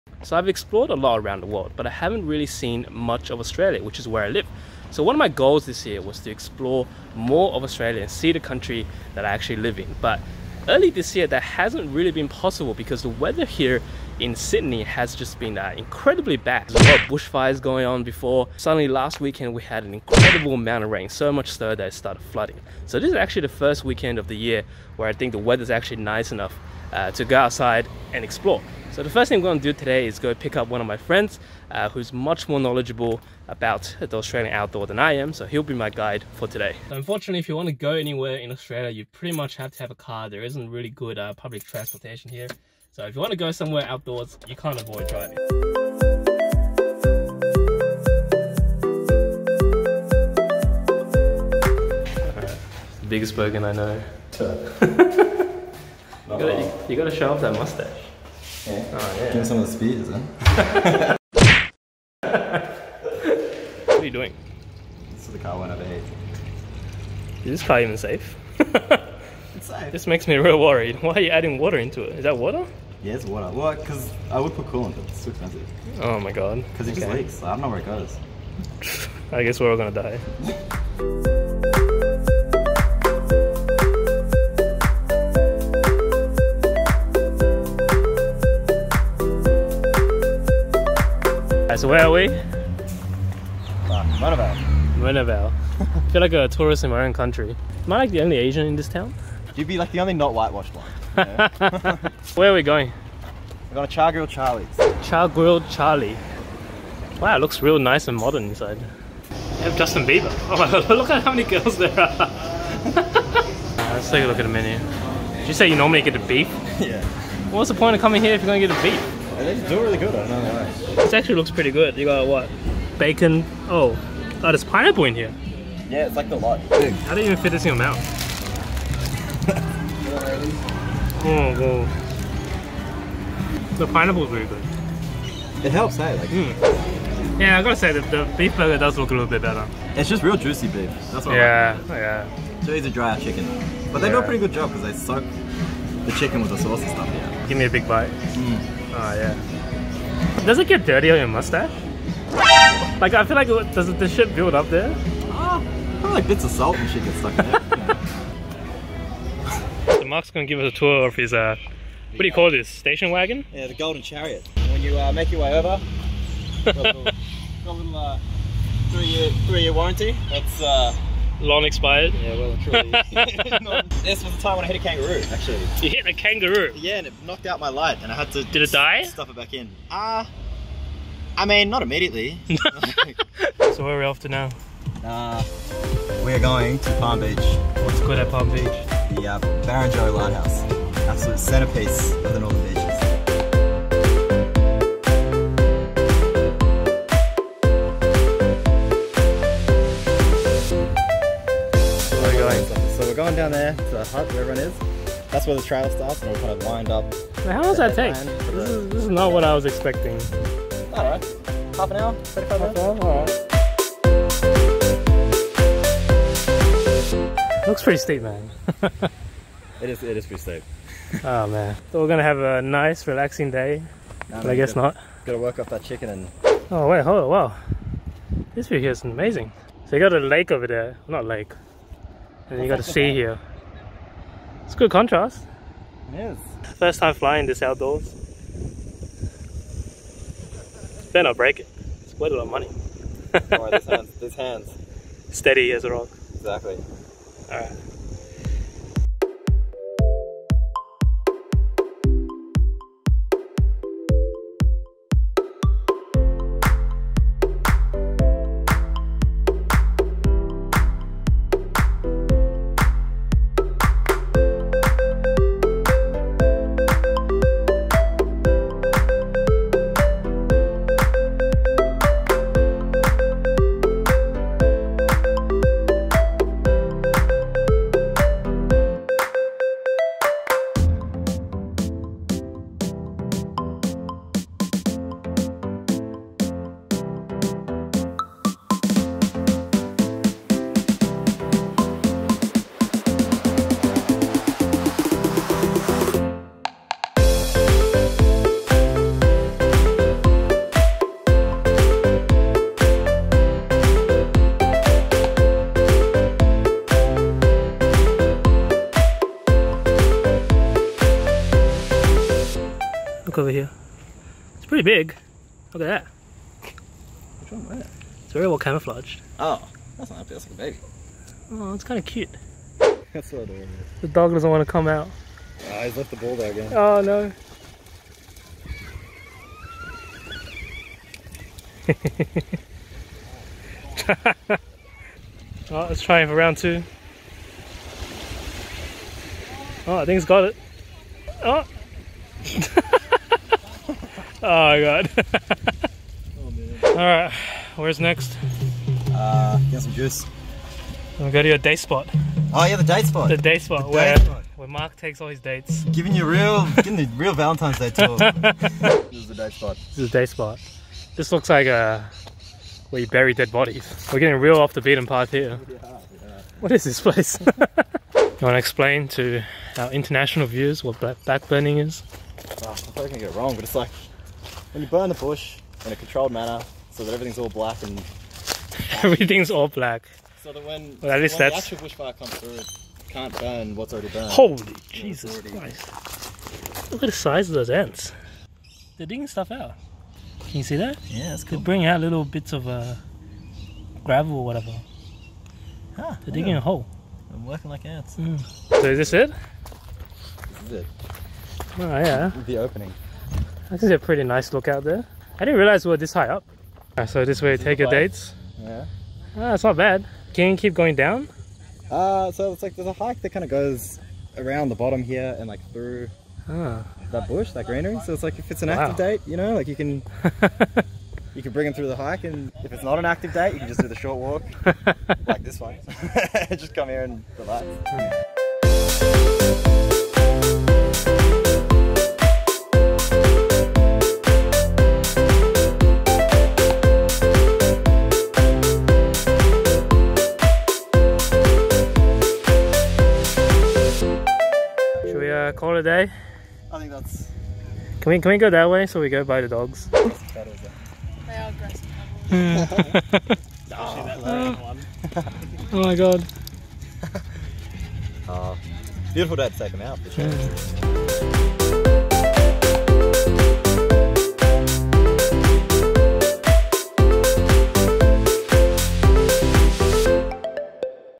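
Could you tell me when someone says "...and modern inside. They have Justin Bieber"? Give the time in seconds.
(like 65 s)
108 s.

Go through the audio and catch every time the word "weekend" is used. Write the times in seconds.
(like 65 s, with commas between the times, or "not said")
19 s, 23 s.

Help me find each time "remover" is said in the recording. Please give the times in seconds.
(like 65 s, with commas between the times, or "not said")
not said.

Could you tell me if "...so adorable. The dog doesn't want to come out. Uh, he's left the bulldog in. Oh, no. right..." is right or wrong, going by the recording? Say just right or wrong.
right.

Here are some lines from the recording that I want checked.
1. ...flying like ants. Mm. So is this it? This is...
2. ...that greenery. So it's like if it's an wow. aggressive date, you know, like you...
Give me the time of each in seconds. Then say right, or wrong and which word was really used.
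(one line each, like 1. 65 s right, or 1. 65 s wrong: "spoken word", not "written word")
1. 397 s wrong: "working", not "flying"
2. 417 s wrong: "active", not "aggressive".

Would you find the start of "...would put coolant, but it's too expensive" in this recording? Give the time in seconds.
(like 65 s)
74 s.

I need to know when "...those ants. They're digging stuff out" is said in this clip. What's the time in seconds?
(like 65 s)
387 s.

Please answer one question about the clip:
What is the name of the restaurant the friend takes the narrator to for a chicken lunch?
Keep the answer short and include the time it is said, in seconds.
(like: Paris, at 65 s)
Chargrilled Charlie's, at 103 s.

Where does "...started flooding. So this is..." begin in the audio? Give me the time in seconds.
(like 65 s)
21 s.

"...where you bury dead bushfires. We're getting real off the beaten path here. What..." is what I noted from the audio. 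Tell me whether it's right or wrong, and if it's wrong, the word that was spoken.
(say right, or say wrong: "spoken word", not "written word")
wrong: "bodies", not "bushfires".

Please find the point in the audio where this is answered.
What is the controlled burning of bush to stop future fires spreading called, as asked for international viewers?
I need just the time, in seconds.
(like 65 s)
371 s.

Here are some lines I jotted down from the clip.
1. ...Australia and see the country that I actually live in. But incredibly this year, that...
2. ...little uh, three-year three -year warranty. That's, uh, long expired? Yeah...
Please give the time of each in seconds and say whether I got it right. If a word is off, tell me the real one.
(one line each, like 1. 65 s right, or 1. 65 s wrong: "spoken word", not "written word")
1. 7 s wrong: "early", not "incredibly"
2. 167 s right.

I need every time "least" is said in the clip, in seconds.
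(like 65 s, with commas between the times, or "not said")
381 s.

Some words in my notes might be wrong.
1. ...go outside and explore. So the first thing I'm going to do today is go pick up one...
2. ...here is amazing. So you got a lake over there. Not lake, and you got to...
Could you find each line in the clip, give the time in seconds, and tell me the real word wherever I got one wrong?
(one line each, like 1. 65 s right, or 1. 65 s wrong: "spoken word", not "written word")
1. 27 s right
2. 228 s right.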